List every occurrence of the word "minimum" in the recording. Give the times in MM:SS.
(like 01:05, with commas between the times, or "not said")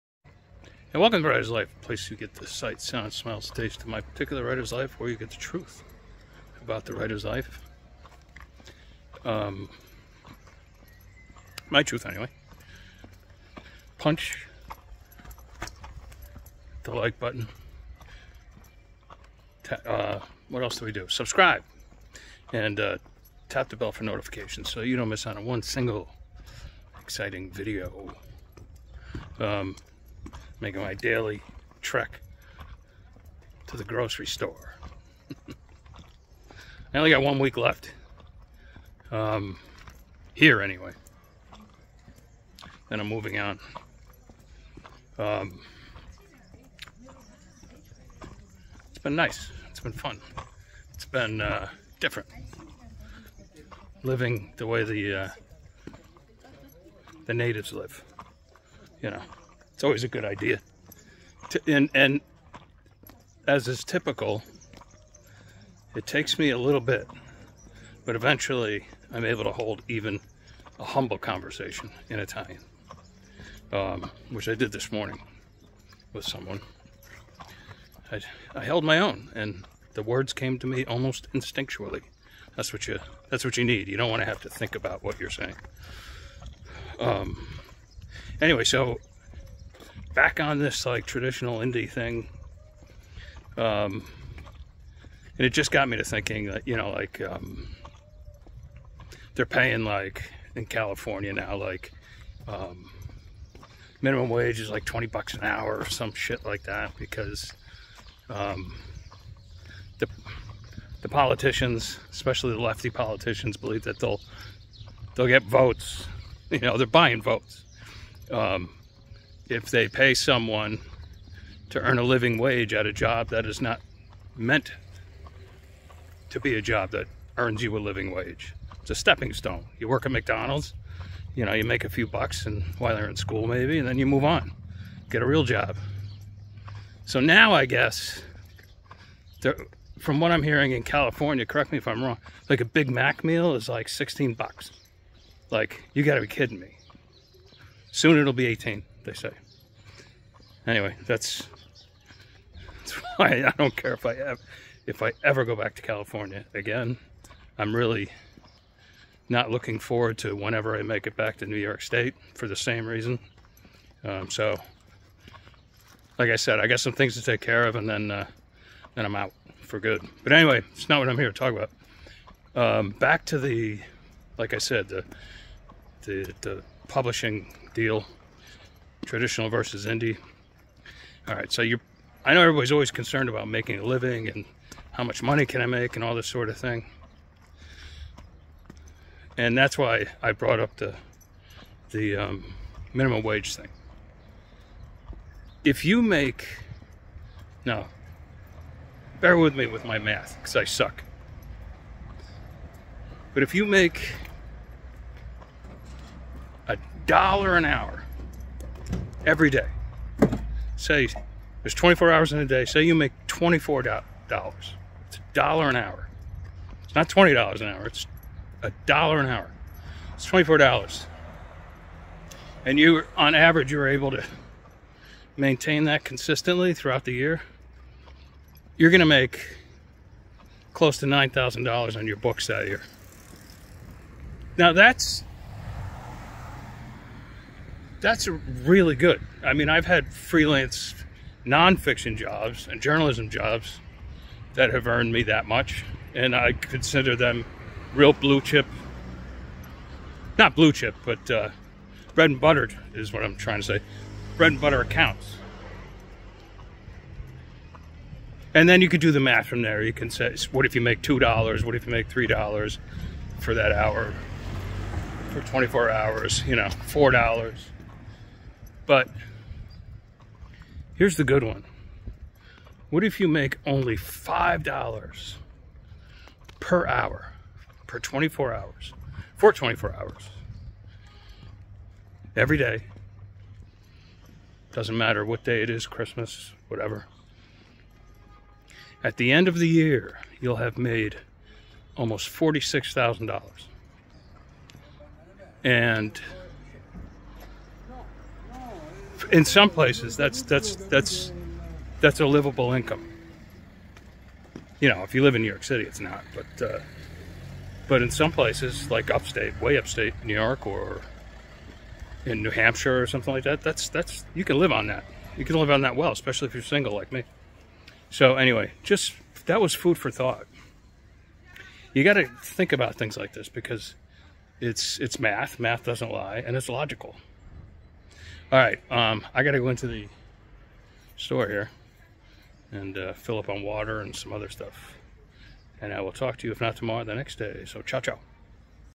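01:44, 03:12.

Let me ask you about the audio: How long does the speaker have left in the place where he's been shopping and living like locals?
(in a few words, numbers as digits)
1 week.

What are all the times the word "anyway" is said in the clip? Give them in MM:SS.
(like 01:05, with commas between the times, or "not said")
00:12, 00:40, 01:28, 02:30, 02:50, 05:18.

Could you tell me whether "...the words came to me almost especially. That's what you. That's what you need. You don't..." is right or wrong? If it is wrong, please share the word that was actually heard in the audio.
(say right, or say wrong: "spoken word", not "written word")
wrong: "instinctually", not "especially".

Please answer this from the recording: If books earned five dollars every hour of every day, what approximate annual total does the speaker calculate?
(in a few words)
$46,000.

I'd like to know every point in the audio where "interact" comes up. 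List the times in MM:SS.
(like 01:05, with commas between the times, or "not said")
not said.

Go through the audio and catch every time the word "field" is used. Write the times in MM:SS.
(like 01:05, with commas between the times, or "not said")
not said.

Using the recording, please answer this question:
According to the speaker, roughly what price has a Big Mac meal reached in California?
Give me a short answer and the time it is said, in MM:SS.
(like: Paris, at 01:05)
$16, at 02:23.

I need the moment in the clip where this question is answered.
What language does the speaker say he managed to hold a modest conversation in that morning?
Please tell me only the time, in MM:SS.
01:12.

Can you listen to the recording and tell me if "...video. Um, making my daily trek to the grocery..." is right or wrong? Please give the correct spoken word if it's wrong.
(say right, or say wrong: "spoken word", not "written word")
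right.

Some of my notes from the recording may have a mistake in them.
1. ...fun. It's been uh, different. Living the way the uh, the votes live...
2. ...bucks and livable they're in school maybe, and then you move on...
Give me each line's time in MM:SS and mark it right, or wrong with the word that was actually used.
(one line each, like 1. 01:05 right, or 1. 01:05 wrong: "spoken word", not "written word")
1. 00:49 wrong: "natives", not "votes"
2. 02:12 wrong: "while", not "livable".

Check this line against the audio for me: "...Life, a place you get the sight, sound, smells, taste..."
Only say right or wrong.
right.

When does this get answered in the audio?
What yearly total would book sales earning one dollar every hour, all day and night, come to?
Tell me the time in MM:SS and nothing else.
03:51.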